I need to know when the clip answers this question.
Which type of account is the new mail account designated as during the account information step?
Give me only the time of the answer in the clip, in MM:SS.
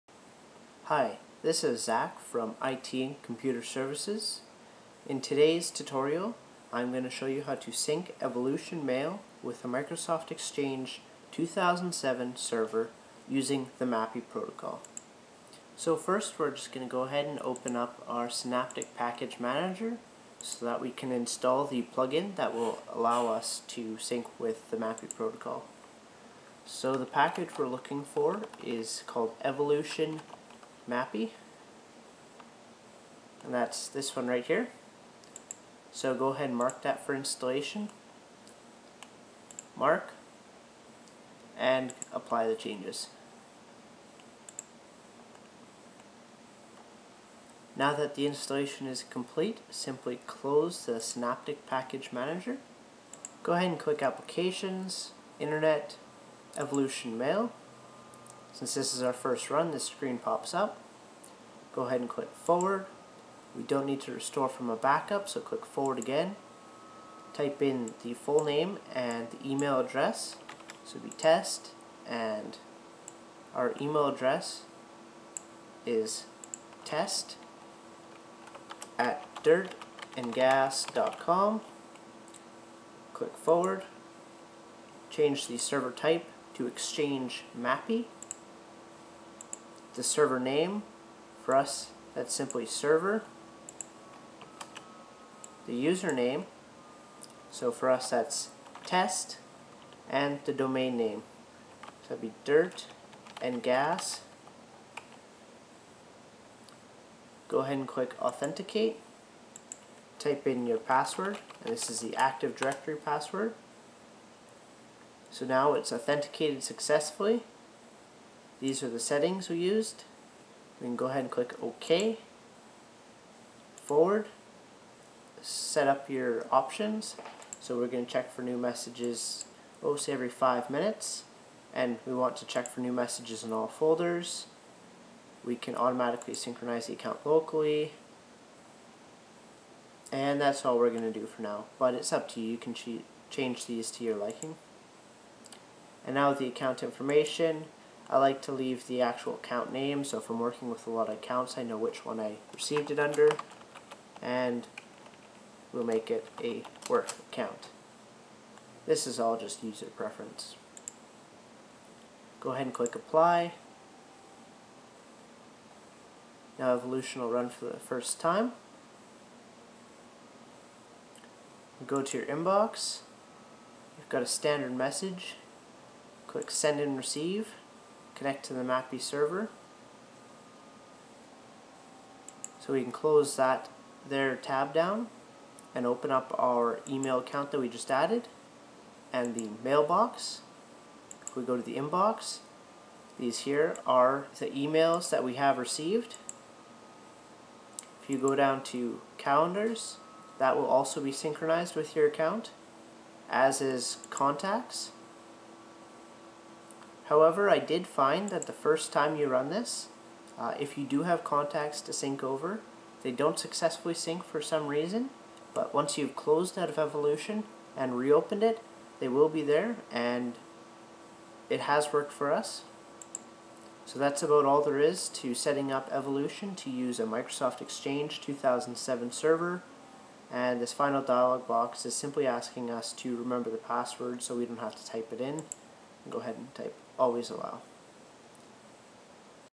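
02:36.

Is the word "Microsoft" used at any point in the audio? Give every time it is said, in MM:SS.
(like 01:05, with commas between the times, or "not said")
00:09, 03:47.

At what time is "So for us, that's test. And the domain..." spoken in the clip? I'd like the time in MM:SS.
01:37.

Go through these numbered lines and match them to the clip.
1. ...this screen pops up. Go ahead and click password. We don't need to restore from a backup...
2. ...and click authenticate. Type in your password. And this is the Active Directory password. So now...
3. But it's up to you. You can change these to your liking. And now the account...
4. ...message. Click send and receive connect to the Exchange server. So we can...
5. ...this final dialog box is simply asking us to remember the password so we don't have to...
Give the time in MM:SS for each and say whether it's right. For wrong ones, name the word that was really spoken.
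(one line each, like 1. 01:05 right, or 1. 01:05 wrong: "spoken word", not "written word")
1. 00:59 wrong: "forward", not "password"
2. 01:47 right
3. 02:21 right
4. 02:54 wrong: "MAPI", not "Exchange"
5. 03:50 right.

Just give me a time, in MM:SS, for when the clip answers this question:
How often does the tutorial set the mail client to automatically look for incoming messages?
02:10.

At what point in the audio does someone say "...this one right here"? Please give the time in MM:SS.
00:33.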